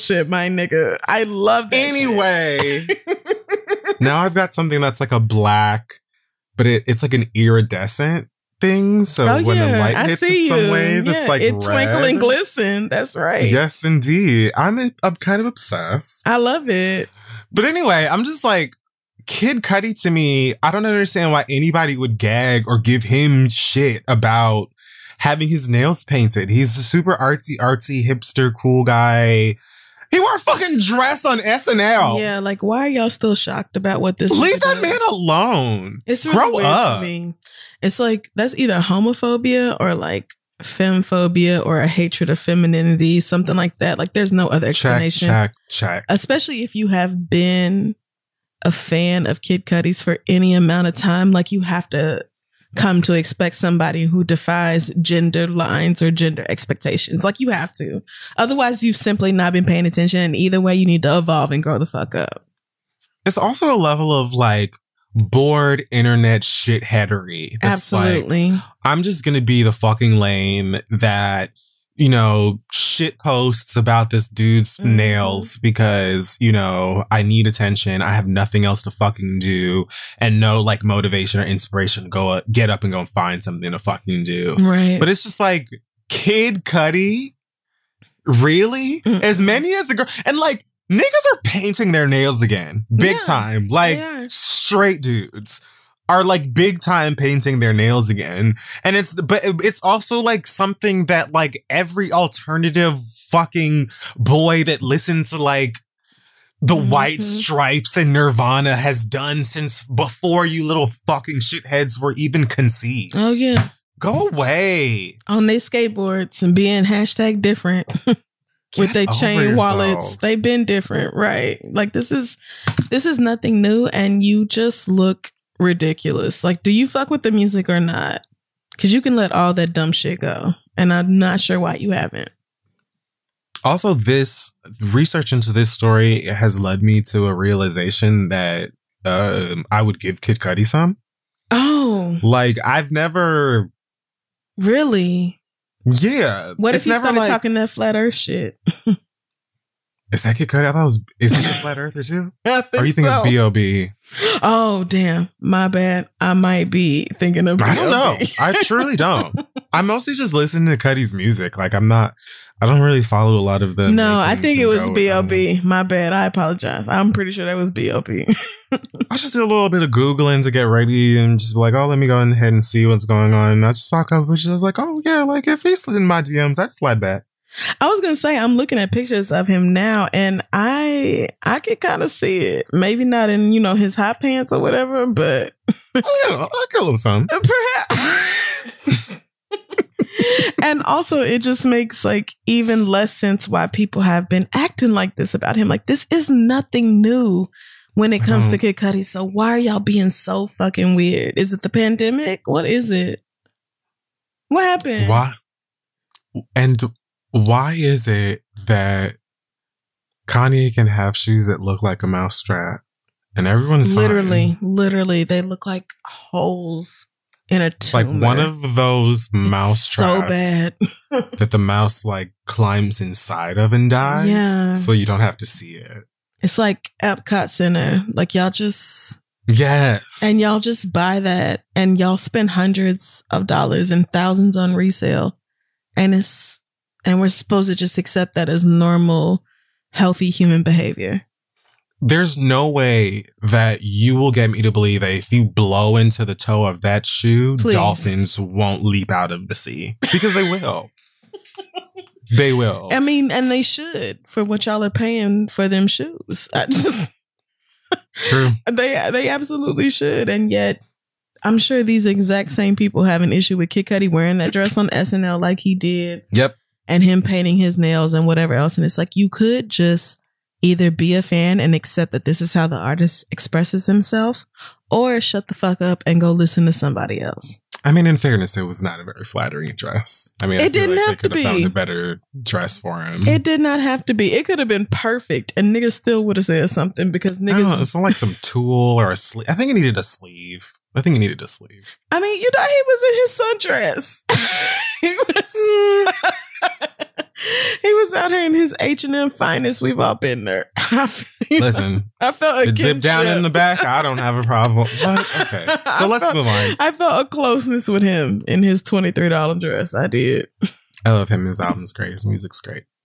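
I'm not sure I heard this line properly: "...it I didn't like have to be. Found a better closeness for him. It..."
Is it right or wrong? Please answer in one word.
wrong.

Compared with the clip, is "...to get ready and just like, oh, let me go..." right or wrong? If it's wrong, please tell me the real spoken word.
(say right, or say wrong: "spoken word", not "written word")
right.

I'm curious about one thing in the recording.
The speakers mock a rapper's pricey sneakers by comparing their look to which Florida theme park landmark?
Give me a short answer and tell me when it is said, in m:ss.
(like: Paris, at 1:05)
Epcot Center, at 3:47.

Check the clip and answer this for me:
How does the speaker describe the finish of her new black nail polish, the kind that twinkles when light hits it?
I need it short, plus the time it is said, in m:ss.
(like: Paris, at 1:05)
iridescent, at 0:07.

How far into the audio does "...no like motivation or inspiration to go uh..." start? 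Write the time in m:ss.
1:20.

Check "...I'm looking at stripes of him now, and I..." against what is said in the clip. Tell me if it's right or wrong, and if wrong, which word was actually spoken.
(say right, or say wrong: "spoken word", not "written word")
wrong: "pictures", not "stripes".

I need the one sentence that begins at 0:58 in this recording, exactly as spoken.
Otherwise, you've simply not been paying attention.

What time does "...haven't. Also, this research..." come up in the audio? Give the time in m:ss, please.
2:11.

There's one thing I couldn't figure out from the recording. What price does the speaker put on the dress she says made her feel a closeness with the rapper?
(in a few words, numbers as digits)
$23.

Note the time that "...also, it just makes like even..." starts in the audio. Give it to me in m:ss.
3:10.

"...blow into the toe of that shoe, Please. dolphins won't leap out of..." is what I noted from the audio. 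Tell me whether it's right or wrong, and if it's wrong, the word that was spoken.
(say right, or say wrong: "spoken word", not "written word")
right.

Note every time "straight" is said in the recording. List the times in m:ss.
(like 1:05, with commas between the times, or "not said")
1:34.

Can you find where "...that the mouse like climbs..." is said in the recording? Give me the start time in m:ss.
3:41.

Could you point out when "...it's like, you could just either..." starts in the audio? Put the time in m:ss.
4:28.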